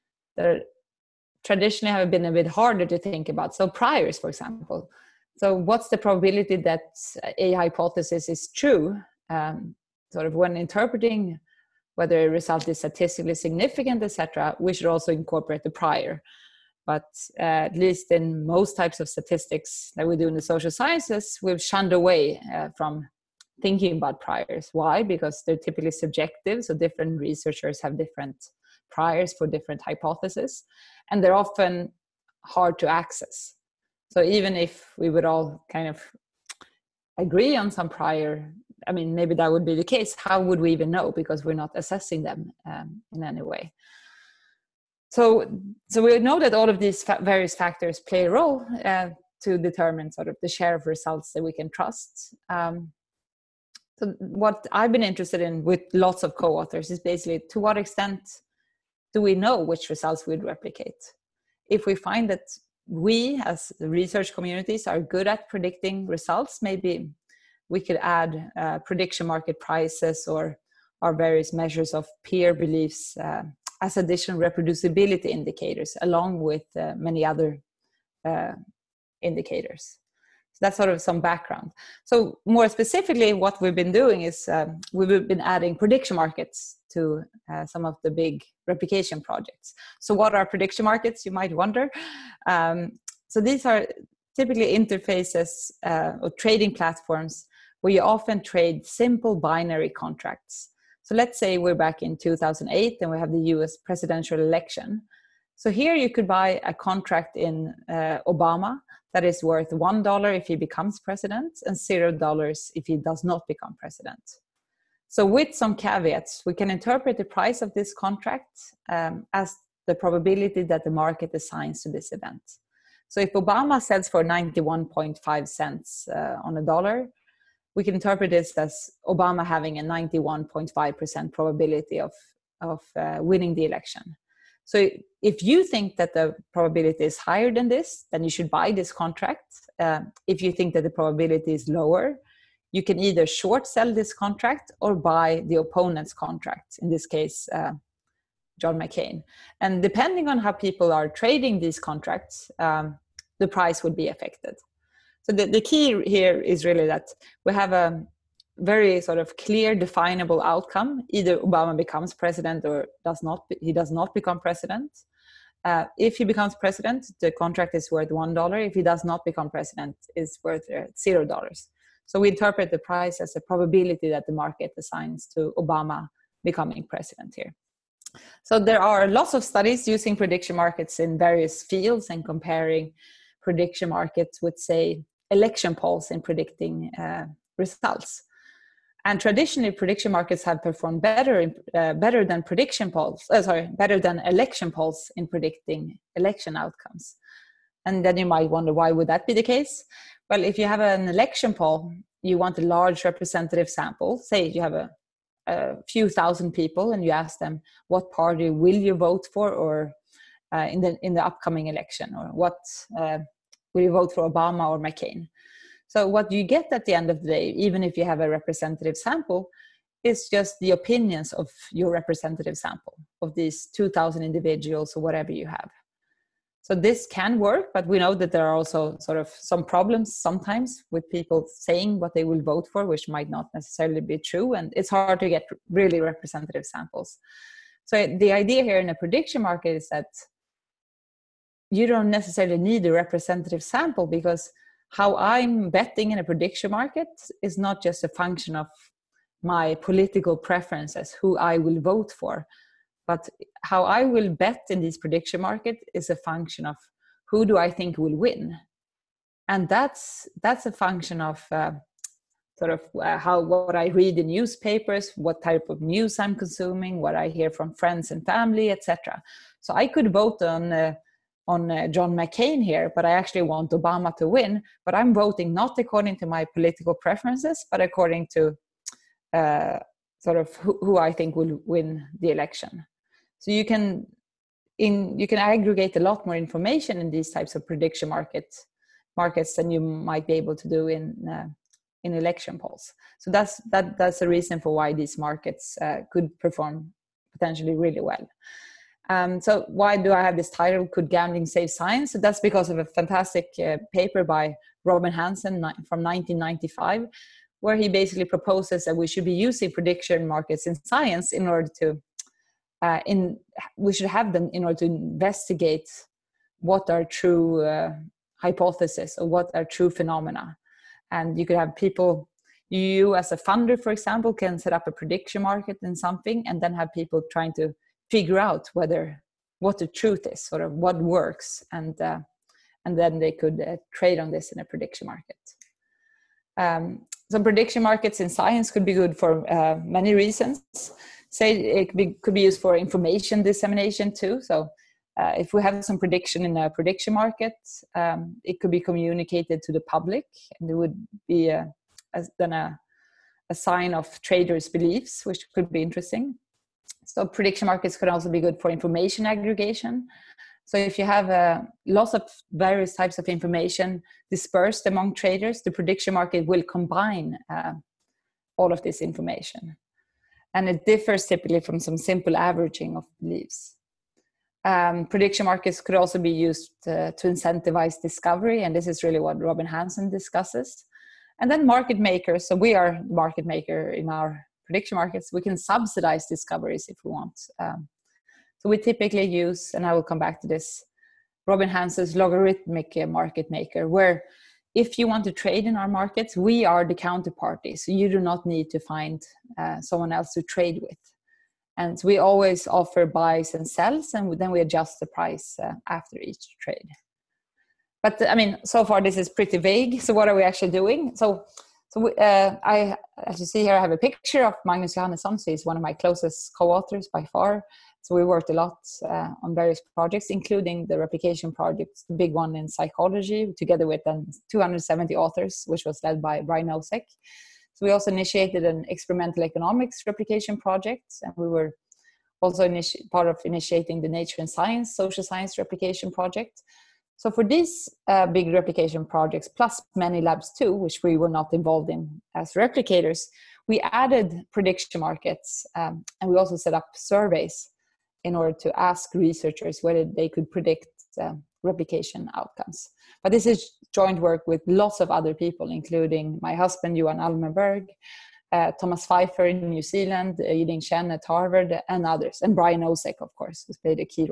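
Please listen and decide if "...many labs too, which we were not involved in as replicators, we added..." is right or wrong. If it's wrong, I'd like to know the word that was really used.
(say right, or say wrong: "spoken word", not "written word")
right.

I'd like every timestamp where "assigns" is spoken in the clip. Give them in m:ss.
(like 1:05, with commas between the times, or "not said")
2:01, 2:54.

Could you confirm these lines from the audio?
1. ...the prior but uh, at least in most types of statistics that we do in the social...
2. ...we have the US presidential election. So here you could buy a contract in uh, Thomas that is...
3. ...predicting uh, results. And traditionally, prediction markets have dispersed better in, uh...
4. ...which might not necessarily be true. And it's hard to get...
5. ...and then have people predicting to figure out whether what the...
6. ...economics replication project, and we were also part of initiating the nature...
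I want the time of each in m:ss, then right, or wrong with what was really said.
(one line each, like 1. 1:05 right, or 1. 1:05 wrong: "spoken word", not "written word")
1. 0:15 right
2. 1:43 wrong: "Obama", not "Thomas"
3. 3:06 wrong: "performed", not "dispersed"
4. 3:52 right
5. 5:26 wrong: "trying", not "predicting"
6. 7:09 right.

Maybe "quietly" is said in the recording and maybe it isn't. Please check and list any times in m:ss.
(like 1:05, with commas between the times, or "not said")
not said.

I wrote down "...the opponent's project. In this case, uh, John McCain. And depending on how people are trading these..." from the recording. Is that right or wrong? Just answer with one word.
wrong.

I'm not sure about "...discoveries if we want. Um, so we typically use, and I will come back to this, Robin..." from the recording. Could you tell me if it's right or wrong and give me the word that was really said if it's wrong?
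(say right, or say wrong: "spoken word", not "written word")
right.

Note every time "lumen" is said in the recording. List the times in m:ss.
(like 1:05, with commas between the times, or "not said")
not said.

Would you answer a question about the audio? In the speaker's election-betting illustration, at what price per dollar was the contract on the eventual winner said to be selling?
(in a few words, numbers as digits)
91.5 cents.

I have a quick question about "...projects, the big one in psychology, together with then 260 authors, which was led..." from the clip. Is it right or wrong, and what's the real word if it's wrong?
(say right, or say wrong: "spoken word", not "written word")
wrong: "270", not "260".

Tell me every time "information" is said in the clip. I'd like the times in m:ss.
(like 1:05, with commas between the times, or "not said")
4:46, 5:42, 5:58, 6:03, 6:09.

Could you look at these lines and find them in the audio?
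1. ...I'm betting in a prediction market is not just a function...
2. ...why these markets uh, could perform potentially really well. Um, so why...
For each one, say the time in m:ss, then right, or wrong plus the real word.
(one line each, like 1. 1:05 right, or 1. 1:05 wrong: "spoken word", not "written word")
1. 4:05 right
2. 4:54 right.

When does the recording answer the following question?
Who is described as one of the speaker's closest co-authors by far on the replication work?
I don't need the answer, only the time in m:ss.
6:54.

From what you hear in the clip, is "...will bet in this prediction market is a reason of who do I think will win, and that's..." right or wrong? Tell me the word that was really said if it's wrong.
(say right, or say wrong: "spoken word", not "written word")
wrong: "function", not "reason".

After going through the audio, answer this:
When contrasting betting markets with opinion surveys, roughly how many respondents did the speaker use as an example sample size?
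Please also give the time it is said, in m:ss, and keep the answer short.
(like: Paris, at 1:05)
2,000, at 3:43.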